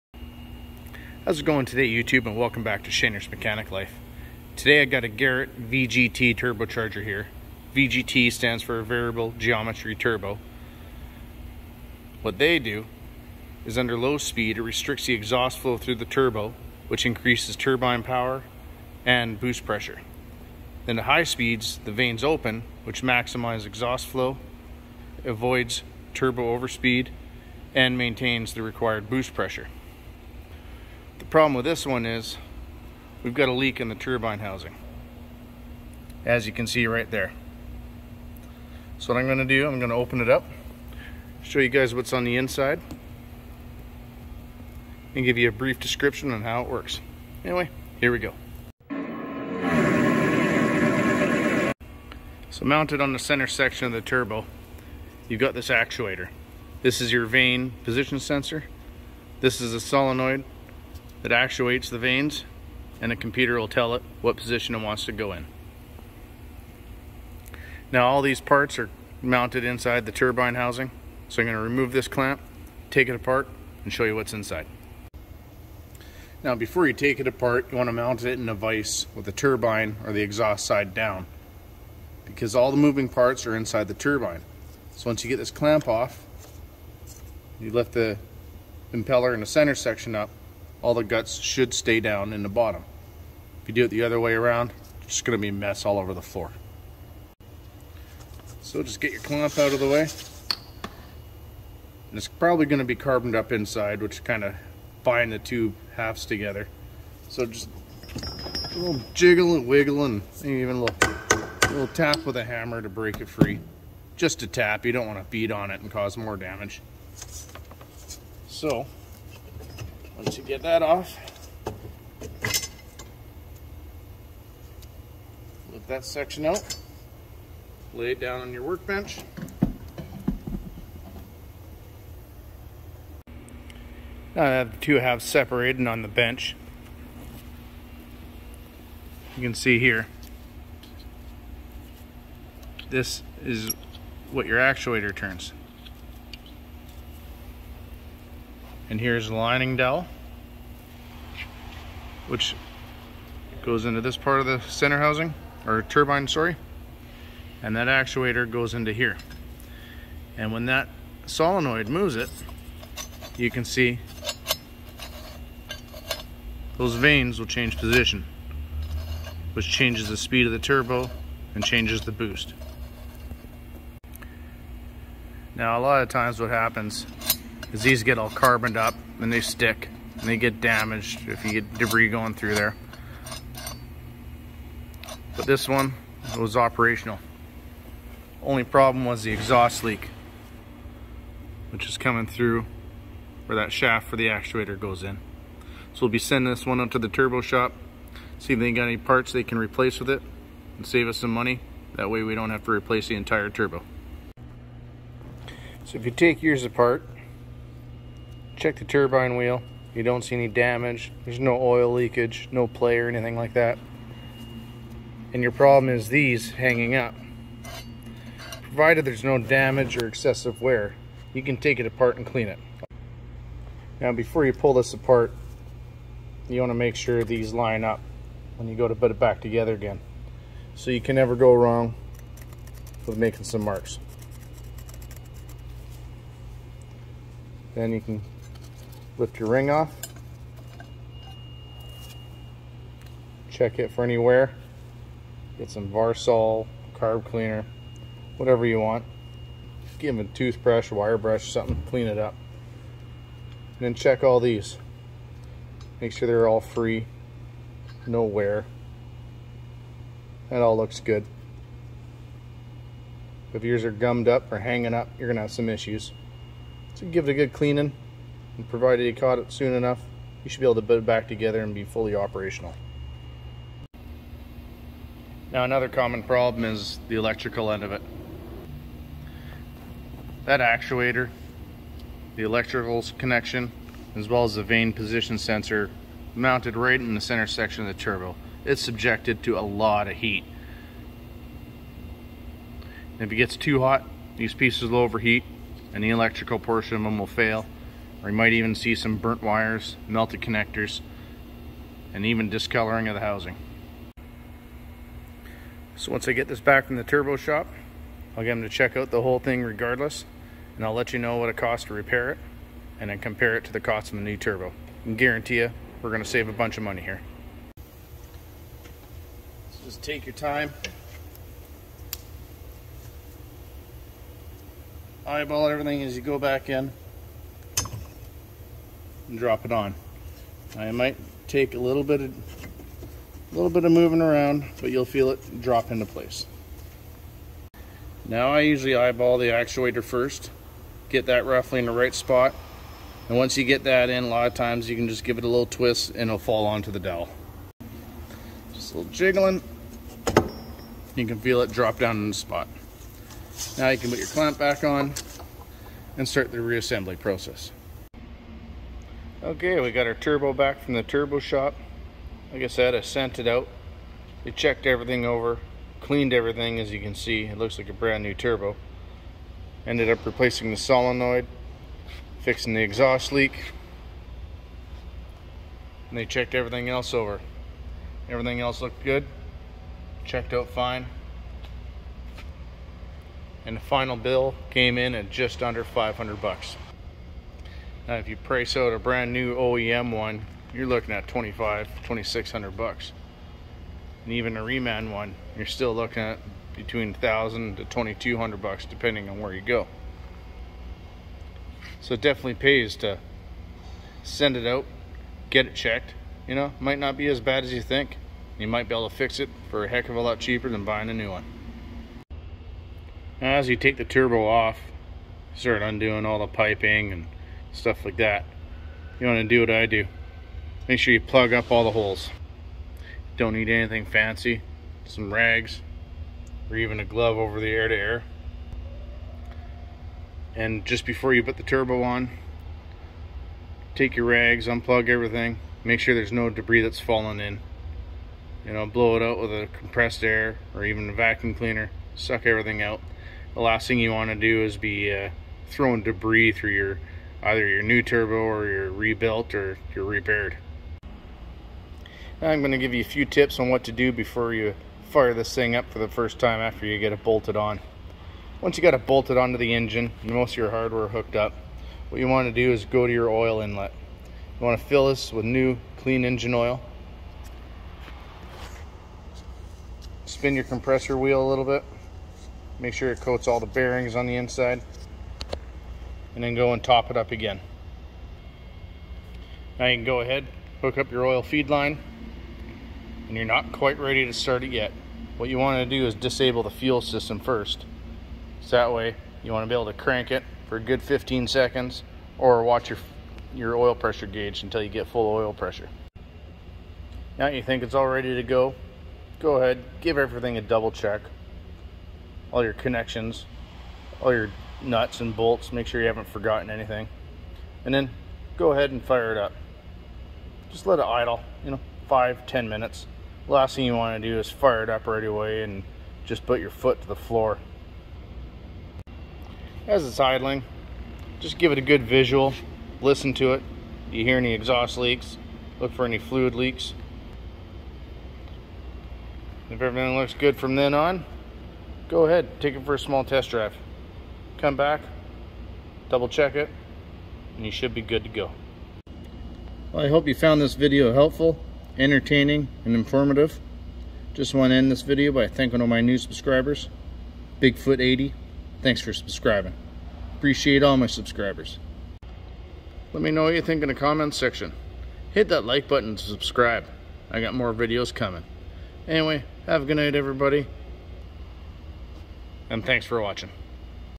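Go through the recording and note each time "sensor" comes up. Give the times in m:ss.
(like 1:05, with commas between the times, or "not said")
0:58, 4:45.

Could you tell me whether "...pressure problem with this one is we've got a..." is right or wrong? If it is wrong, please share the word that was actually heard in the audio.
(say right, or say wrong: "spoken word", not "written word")
right.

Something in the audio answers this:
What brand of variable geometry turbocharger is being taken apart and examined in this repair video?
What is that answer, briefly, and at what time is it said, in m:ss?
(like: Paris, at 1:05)
Garrett, at 0:05.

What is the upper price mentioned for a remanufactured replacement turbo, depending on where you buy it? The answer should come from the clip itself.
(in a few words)
$2200.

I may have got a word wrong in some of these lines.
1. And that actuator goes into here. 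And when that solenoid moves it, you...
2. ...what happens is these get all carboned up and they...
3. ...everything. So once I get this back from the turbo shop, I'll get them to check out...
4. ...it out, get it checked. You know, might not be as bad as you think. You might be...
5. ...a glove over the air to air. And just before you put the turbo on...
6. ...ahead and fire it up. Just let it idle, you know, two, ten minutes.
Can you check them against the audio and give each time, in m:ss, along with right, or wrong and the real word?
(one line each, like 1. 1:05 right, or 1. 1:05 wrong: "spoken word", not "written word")
1. 2:37 right
2. 2:56 right
3. 5:03 wrong: "housing", not "everything"
4. 6:44 right
5. 7:06 right
6. 8:28 wrong: "five", not "two".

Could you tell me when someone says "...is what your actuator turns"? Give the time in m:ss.
2:23.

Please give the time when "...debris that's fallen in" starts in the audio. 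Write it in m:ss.
7:16.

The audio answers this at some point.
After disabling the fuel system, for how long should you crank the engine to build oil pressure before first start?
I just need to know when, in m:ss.
8:11.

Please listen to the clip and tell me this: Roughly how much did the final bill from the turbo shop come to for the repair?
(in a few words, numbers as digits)
Just under $500.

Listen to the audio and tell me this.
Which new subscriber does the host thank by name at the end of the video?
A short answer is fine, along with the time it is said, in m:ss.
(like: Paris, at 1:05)
Bigfoot80, at 9:07.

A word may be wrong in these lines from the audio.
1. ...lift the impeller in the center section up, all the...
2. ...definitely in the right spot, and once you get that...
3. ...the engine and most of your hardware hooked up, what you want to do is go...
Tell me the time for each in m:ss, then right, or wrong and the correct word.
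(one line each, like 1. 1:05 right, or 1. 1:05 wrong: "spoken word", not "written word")
1. 1:27 right
2. 5:41 wrong: "roughly", not "definitely"
3. 7:39 right.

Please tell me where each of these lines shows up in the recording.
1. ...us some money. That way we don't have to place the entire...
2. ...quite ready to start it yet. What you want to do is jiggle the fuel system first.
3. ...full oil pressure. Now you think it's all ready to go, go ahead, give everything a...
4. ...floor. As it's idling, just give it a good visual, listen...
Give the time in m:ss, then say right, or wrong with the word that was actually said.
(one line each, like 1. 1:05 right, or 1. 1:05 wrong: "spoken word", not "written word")
1. 3:21 wrong: "replace", not "place"
2. 8:03 wrong: "disable", not "jiggle"
3. 8:15 right
4. 8:37 right.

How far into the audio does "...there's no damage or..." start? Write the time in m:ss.
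3:39.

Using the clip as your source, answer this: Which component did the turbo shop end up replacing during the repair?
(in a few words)
The solenoid.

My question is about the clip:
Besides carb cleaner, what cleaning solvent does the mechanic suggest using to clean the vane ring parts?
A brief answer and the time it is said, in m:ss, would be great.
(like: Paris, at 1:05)
Varsol, at 4:05.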